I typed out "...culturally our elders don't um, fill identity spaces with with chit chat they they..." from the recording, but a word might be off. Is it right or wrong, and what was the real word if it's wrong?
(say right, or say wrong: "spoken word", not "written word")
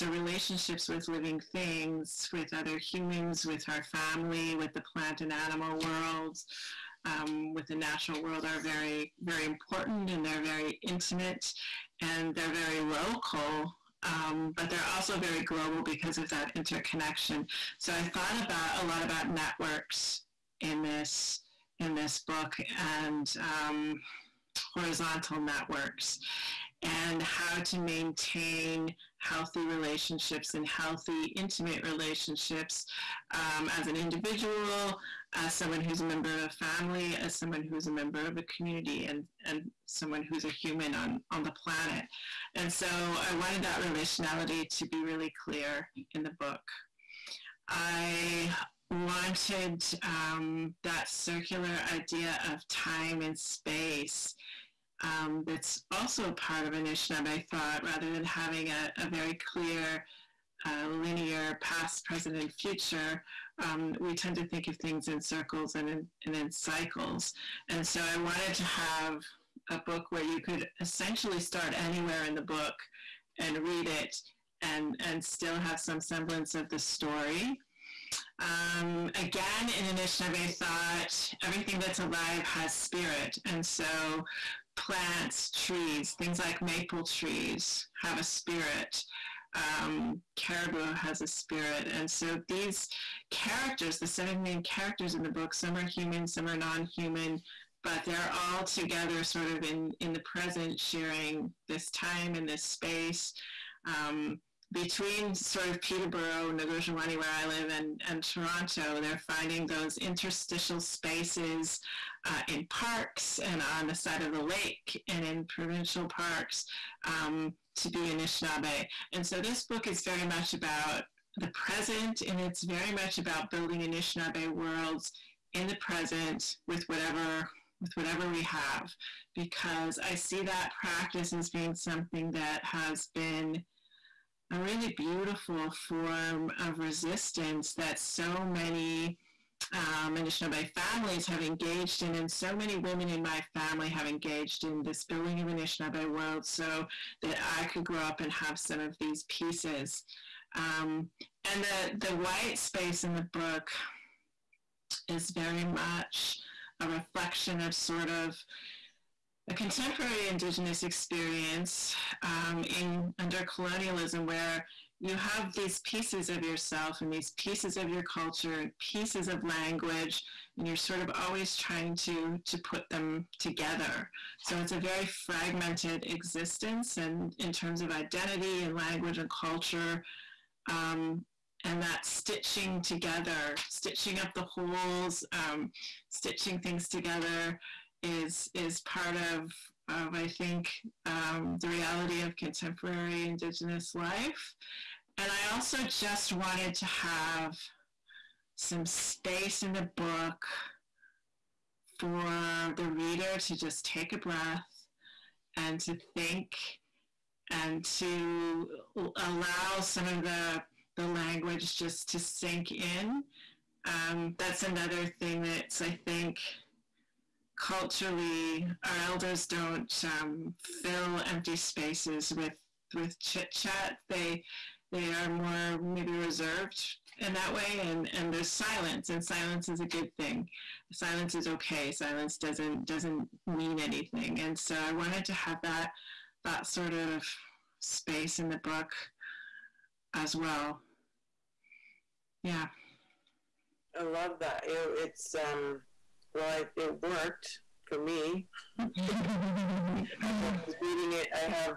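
wrong: "empty", not "identity".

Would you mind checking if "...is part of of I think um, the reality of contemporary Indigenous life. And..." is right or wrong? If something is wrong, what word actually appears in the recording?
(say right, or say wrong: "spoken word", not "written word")
right.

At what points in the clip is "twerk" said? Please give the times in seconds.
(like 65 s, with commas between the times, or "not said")
not said.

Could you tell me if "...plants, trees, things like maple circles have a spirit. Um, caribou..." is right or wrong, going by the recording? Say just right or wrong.
wrong.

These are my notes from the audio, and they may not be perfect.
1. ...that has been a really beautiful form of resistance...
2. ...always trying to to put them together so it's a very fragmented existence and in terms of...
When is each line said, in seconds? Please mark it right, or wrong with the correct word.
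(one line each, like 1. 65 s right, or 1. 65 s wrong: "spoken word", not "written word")
1. 132 s right
2. 171 s right.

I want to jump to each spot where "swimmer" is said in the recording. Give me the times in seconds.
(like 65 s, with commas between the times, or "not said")
not said.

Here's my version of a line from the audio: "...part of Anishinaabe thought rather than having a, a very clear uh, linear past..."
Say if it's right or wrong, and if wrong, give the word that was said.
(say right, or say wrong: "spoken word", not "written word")
right.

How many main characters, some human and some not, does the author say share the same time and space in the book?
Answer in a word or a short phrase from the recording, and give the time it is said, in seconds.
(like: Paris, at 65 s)
7, at 94 s.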